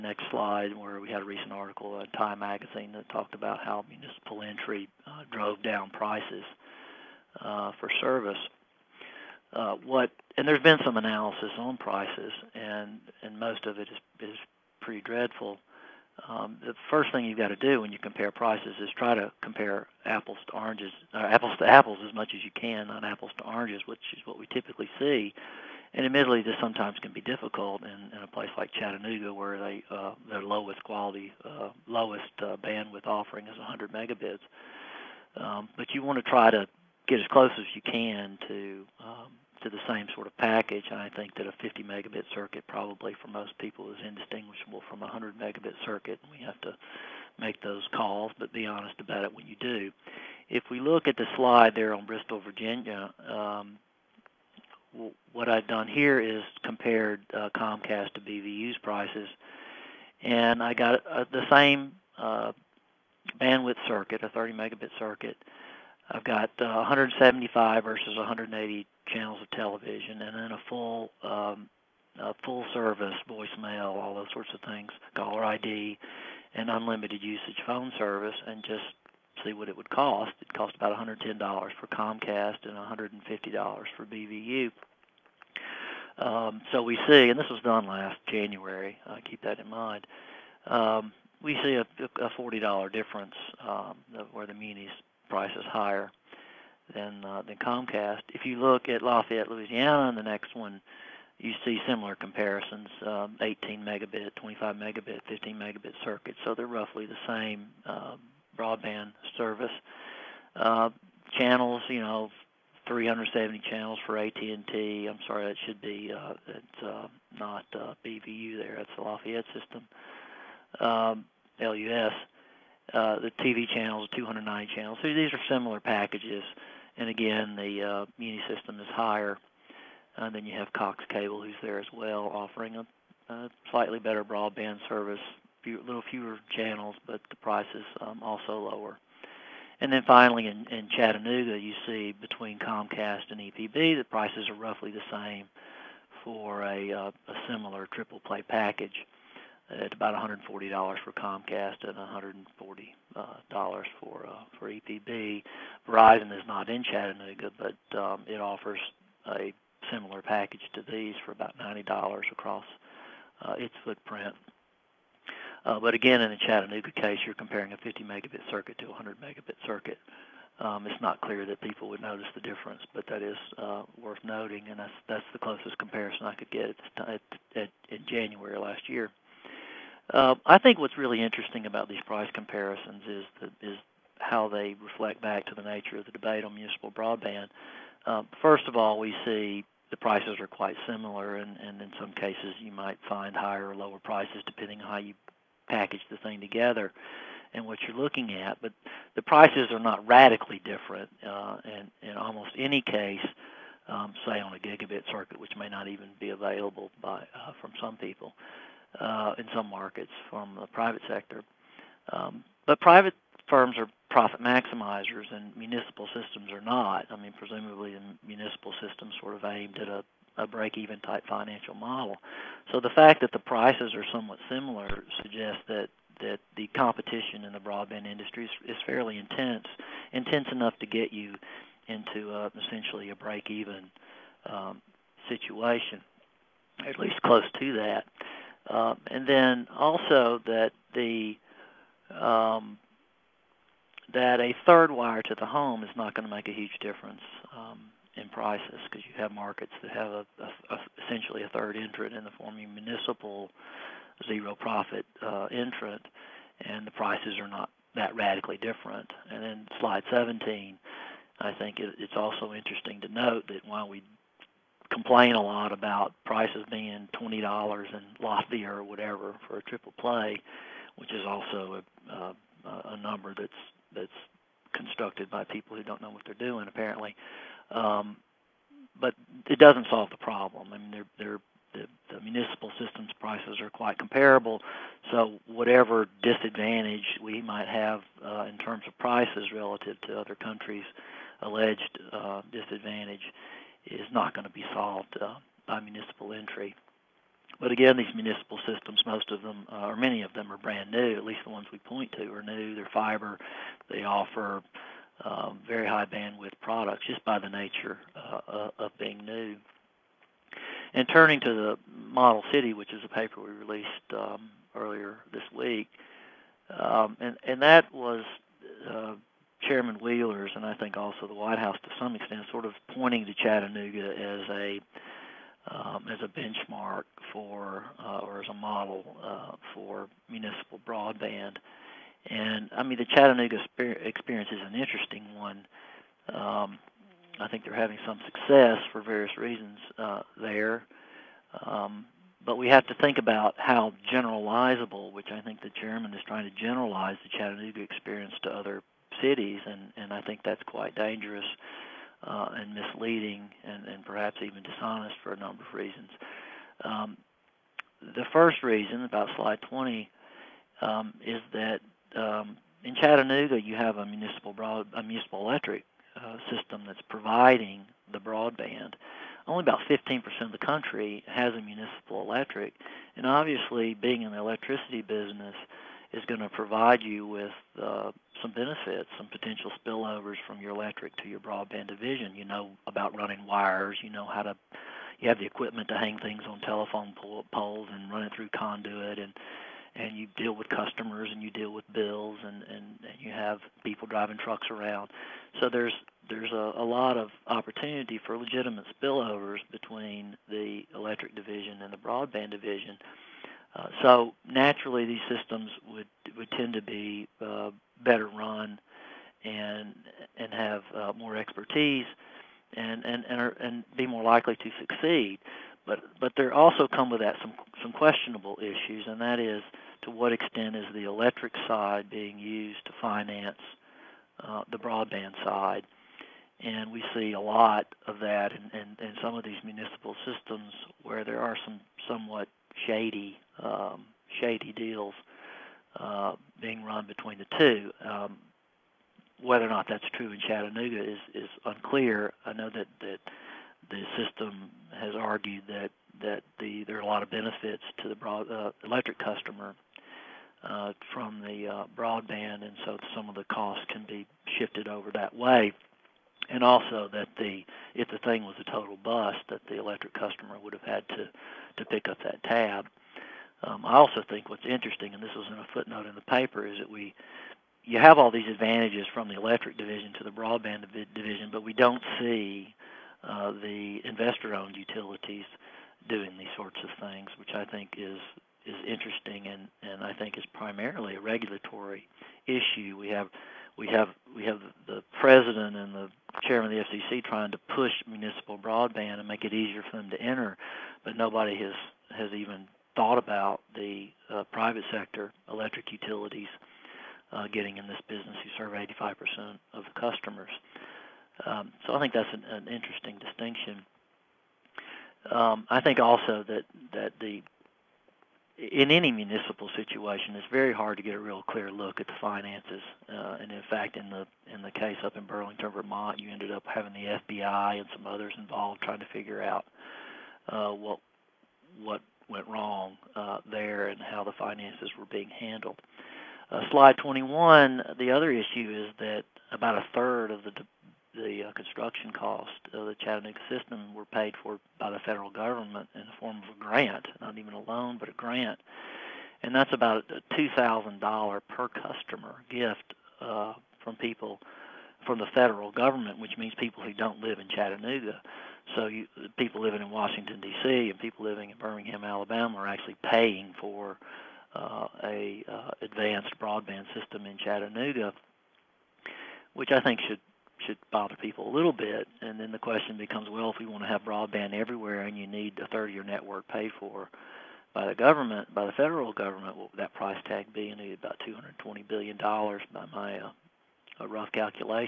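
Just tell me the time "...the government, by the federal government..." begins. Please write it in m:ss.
9:27.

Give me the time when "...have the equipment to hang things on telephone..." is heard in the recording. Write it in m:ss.
6:25.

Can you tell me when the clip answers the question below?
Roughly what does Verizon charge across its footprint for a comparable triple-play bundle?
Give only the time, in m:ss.
2:41.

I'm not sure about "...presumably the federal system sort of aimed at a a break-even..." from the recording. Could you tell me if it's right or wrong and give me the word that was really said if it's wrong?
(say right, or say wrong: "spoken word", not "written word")
wrong: "municipal", not "federal".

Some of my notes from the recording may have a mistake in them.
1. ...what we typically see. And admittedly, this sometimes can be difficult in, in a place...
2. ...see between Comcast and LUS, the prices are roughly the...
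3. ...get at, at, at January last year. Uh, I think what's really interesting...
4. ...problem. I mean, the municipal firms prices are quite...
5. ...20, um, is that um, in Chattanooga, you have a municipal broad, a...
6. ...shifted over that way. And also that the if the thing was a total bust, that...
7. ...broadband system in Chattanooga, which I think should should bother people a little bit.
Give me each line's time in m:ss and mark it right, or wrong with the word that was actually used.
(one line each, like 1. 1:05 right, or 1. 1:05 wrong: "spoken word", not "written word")
1. 0:24 right
2. 2:21 wrong: "EPB", not "LUS"
3. 2:56 right
4. 4:40 wrong: "systems", not "firms"
5. 5:59 right
6. 7:34 right
7. 9:16 right.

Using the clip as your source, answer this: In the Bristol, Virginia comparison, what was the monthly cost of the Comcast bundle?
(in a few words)
$110.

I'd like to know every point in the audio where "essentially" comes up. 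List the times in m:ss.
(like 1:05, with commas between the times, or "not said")
3:52, 4:11.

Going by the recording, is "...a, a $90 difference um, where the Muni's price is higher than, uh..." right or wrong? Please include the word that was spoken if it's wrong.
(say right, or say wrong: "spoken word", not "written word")
wrong: "40", not "90".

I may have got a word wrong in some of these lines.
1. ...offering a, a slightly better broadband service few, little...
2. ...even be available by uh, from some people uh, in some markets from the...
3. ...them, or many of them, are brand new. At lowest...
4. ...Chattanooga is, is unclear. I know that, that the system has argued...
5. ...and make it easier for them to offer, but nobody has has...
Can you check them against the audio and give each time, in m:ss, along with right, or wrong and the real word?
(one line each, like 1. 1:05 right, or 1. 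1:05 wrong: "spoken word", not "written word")
1. 2:12 right
2. 3:25 right
3. 4:59 wrong: "least", not "lowest"
4. 7:20 right
5. 8:09 wrong: "enter", not "offer".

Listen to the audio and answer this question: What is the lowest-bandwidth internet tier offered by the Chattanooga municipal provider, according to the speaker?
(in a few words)
100 megabits.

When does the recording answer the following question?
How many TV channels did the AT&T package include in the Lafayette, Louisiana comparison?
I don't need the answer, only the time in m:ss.
1:52.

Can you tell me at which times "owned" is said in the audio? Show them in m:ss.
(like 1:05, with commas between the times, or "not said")
7:54.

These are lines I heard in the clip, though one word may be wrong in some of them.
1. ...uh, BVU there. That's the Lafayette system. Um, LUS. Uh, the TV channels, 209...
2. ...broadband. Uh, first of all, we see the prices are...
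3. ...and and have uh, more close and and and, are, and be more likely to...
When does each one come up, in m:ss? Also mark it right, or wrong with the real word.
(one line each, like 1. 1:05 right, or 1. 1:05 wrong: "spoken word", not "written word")
1. 1:57 right
2. 3:06 right
3. 6:49 wrong: "expertise", not "close".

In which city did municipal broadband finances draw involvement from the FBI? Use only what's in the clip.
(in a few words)
Burlington, Vermont.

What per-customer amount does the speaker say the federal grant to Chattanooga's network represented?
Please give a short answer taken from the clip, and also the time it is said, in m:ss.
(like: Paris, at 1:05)
$2,000, at 9:00.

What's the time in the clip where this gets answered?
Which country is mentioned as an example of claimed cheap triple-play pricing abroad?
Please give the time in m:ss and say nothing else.
4:28.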